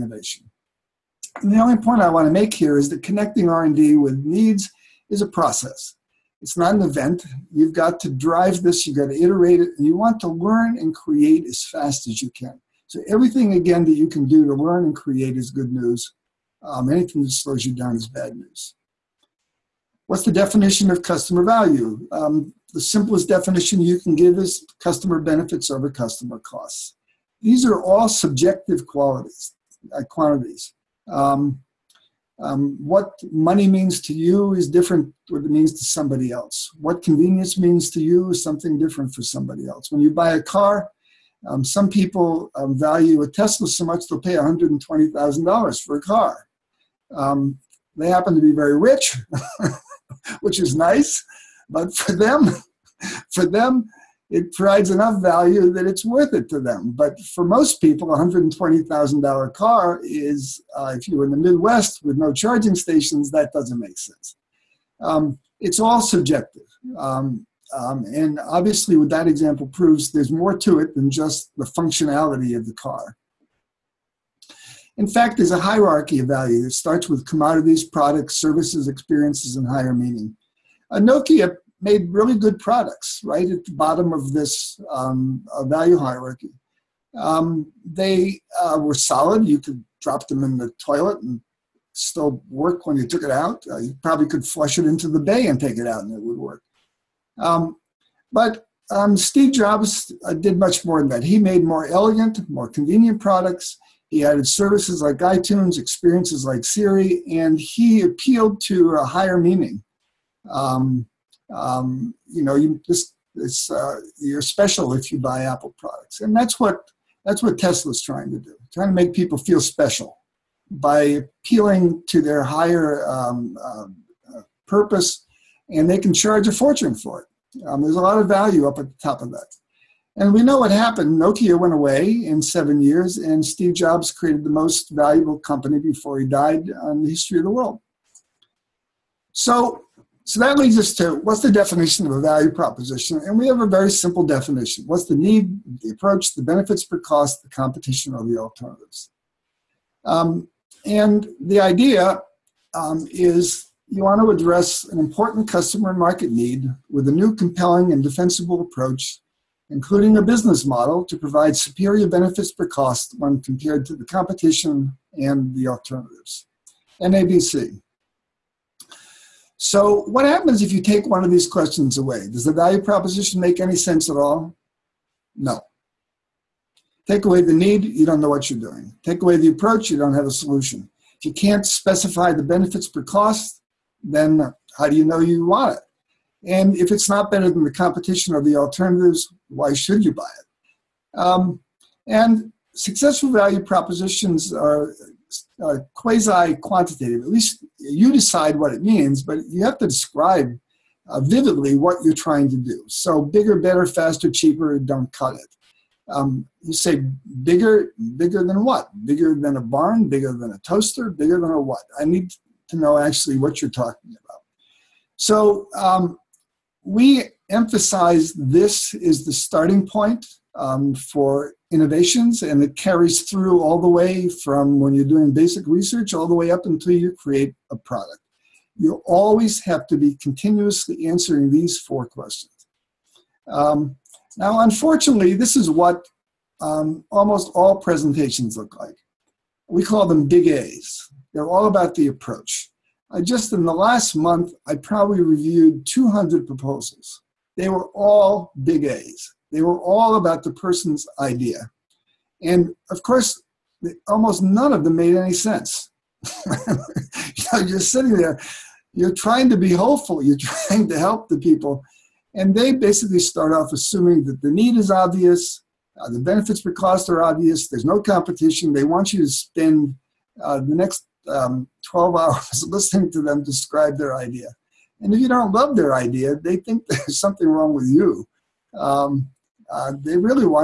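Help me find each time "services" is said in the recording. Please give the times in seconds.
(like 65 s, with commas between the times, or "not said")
78 s, 104 s.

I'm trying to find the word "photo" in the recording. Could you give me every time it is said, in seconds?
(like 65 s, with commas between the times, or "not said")
not said.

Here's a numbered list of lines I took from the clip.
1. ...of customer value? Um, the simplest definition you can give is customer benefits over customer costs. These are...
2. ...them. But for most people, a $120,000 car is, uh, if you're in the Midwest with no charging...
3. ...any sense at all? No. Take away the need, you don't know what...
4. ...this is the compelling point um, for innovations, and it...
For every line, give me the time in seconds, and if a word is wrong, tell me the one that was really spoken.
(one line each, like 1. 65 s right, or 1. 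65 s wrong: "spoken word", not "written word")
1. 20 s right
2. 56 s right
3. 173 s right
4. 218 s wrong: "starting", not "compelling".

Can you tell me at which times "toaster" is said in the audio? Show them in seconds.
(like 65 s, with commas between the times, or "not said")
210 s.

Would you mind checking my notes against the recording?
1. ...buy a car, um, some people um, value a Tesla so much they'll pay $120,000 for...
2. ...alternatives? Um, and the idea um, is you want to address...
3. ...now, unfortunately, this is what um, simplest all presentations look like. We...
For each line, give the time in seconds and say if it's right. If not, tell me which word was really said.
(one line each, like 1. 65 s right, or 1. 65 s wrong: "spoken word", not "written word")
1. 40 s right
2. 148 s right
3. 234 s wrong: "almost", not "simplest".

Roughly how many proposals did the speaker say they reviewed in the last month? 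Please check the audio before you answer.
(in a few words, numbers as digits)
200.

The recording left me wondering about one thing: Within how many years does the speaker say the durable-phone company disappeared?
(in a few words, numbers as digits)
7.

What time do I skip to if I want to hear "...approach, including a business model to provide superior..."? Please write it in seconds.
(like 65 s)
158 s.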